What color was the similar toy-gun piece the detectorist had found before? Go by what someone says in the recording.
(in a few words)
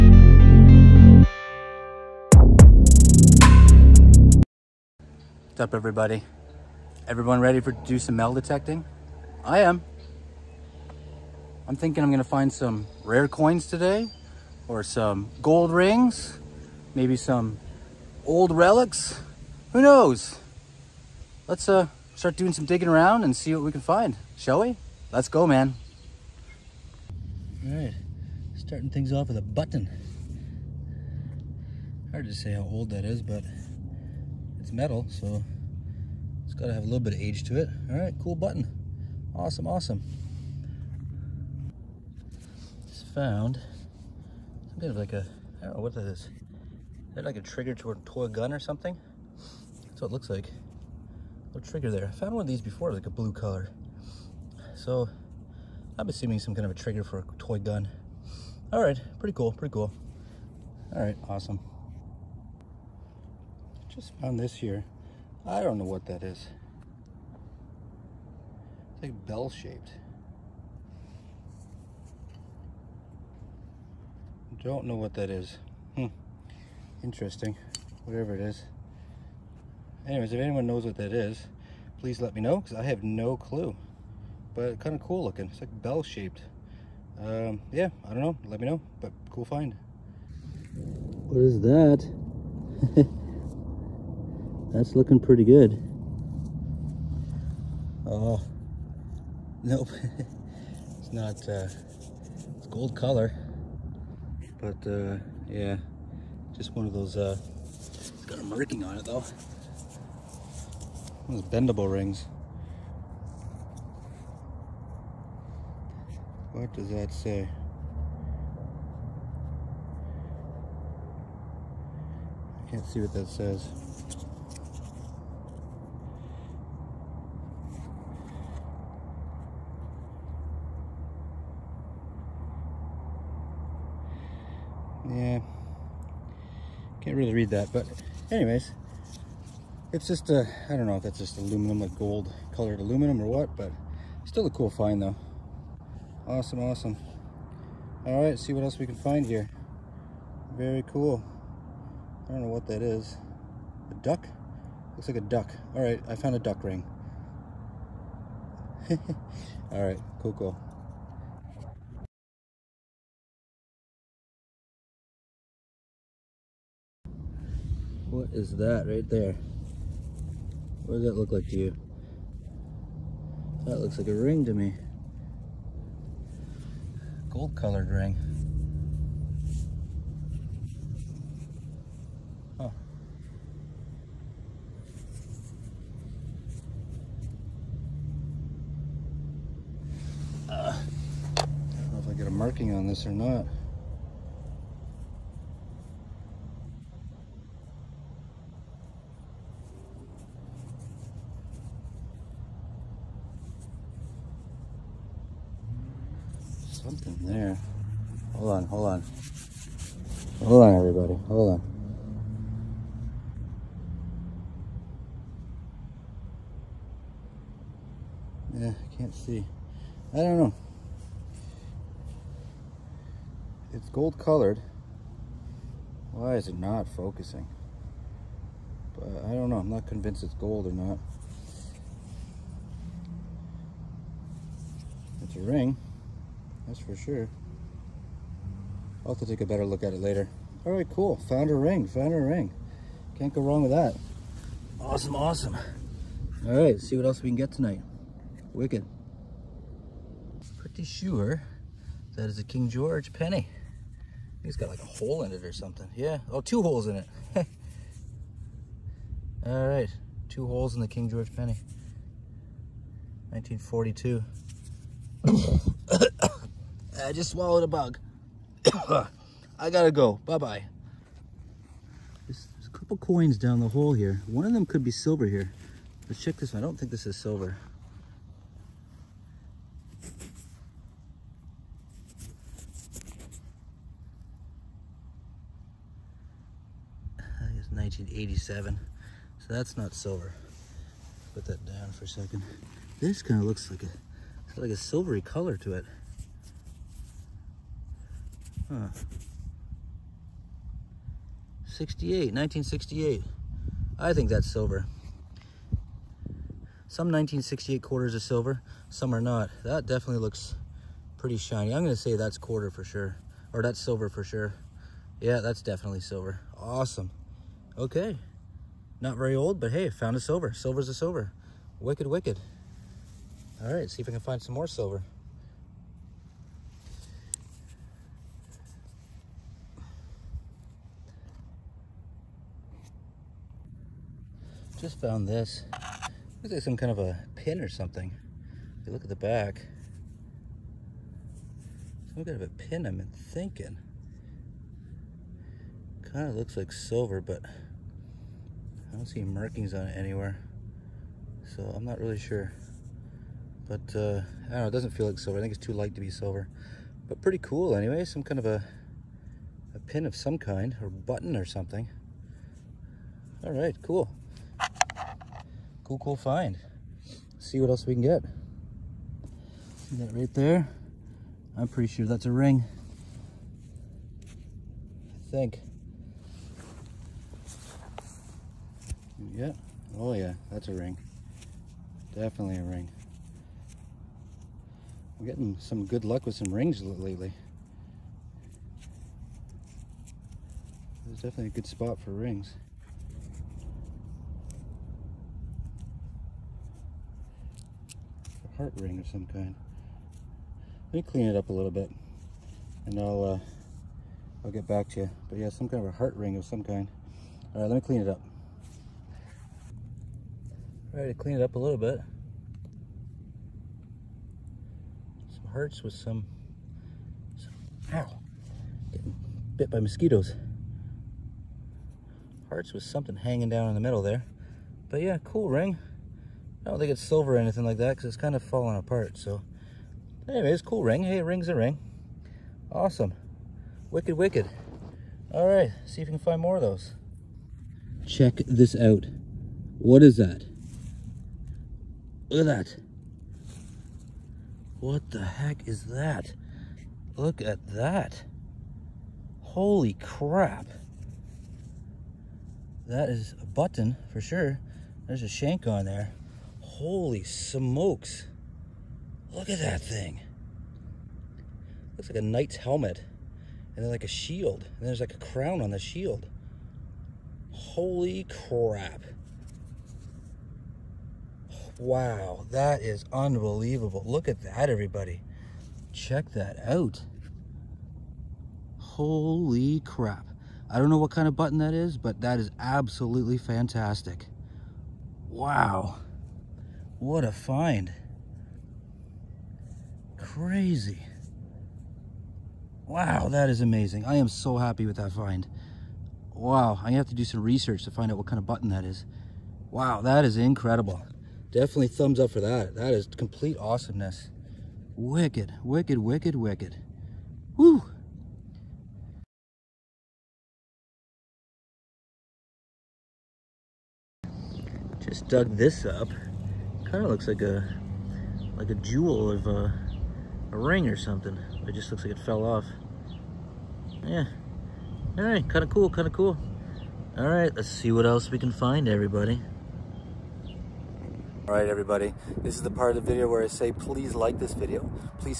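blue.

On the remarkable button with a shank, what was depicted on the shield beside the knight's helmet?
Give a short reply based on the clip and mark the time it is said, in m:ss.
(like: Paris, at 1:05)
a crown, at 7:45.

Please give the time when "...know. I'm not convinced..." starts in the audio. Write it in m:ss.
3:49.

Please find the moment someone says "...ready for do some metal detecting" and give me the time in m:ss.
0:07.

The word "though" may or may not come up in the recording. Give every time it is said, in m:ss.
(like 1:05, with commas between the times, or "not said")
1:49, 2:25.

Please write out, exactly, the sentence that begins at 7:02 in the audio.
Hearts with something hanging down in the middle there.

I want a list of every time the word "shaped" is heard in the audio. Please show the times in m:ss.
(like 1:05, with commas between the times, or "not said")
1:09, 1:26.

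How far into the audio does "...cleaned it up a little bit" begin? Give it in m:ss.
6:51.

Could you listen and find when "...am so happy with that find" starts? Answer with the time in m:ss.
8:14.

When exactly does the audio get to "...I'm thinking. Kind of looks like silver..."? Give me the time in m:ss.
5:42.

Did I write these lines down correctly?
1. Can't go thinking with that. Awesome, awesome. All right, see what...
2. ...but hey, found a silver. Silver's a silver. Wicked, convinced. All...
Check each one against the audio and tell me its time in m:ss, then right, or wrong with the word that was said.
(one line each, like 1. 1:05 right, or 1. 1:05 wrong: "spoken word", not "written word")
1. 4:03 wrong: "wrong", not "thinking"
2. 5:19 wrong: "wicked", not "convinced".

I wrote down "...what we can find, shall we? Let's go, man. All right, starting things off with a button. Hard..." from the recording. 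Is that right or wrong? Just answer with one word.
right.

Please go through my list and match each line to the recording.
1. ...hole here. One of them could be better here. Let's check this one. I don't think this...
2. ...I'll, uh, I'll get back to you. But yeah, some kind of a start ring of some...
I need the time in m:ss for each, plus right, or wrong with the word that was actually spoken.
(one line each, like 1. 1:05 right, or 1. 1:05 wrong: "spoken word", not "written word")
1. 4:33 wrong: "silver", not "better"
2. 6:42 wrong: "heart", not "start".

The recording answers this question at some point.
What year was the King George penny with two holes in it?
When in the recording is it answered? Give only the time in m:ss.
4:23.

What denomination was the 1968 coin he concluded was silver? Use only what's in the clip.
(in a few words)
quarter.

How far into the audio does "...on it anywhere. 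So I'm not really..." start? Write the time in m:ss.
5:49.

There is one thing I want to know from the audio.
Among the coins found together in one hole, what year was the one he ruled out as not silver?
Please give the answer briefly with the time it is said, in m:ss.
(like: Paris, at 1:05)
1987, at 4:47.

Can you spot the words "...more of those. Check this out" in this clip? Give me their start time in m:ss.
7:16.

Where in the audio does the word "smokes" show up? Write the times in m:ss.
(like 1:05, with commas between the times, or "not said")
7:37.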